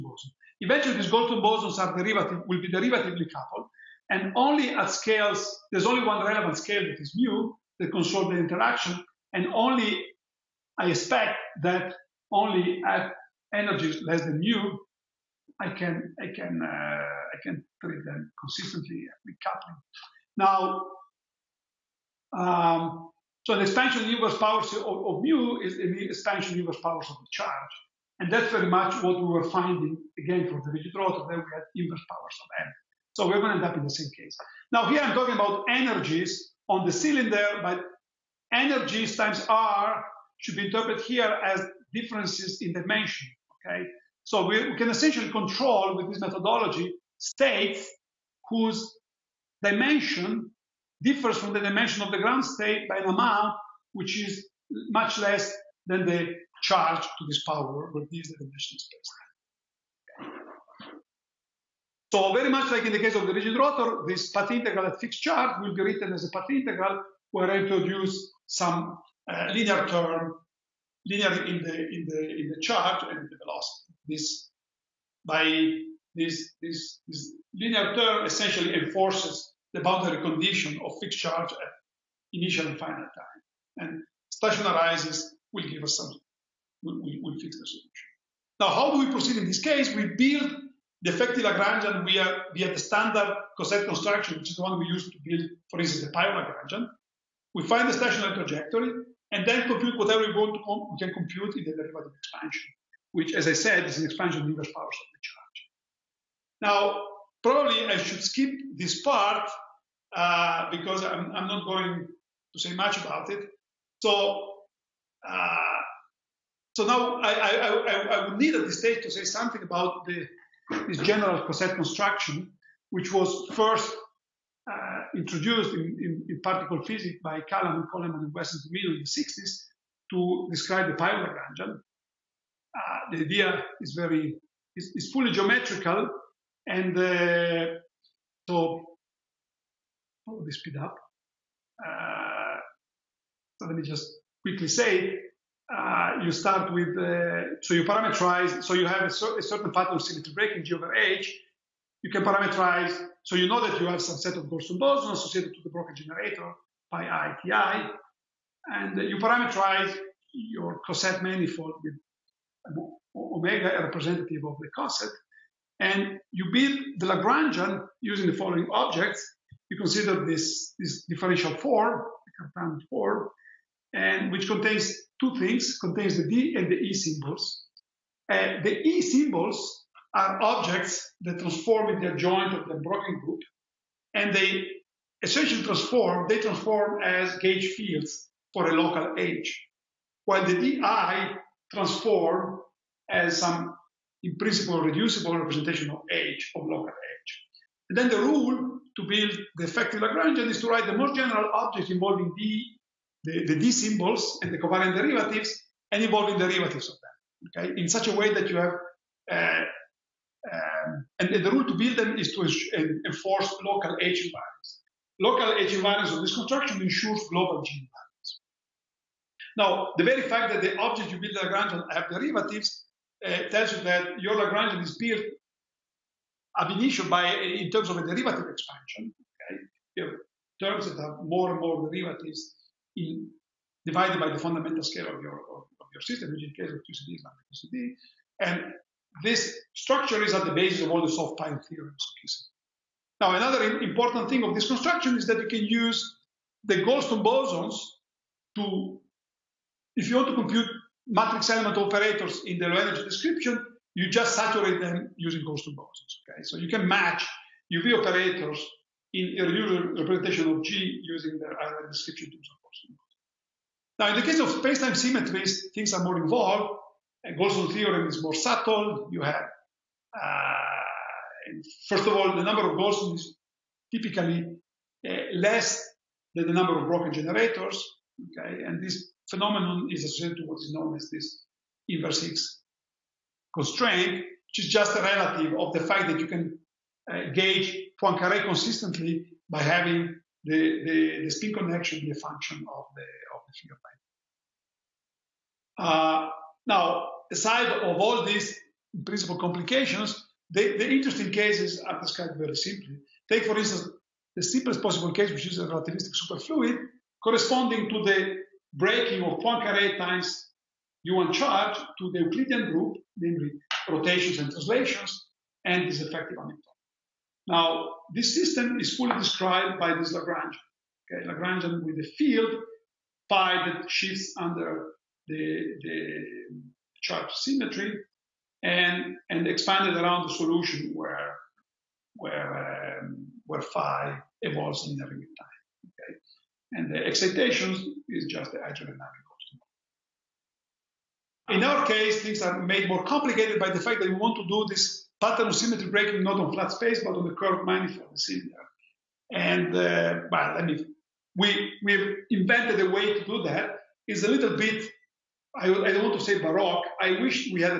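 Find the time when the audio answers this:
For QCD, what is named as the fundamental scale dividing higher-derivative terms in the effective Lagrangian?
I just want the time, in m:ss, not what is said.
3:57.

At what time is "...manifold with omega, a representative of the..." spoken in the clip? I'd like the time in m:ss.
2:41.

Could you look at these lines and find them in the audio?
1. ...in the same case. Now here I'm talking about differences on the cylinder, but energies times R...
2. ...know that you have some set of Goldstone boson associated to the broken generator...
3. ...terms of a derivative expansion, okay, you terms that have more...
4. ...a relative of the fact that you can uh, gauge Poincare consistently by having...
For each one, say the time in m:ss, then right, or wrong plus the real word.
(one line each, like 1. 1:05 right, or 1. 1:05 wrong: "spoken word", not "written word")
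1. 0:33 wrong: "energies", not "differences"
2. 2:33 right
3. 3:47 right
4. 4:44 right.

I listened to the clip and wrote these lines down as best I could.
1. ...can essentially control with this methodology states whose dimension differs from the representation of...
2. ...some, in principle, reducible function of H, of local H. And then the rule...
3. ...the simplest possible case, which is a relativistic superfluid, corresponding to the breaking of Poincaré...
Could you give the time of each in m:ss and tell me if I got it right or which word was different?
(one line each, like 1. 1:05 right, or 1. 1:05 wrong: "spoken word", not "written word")
1. 0:44 wrong: "dimension", not "representation"
2. 3:13 wrong: "representation", not "function"
3. 5:04 right.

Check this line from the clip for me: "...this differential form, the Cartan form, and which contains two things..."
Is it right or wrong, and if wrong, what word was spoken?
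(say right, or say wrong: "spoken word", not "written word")
right.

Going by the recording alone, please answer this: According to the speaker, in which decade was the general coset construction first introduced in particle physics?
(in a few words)
the 60s.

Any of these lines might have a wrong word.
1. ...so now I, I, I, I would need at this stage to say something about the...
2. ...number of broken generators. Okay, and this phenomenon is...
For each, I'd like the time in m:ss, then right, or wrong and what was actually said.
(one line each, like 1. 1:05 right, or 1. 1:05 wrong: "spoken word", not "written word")
1. 1:56 right
2. 4:36 right.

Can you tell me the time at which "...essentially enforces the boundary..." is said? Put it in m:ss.
1:18.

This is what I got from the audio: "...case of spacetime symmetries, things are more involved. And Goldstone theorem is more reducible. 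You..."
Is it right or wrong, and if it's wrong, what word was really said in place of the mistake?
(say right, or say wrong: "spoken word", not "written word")
wrong: "subtle", not "reducible".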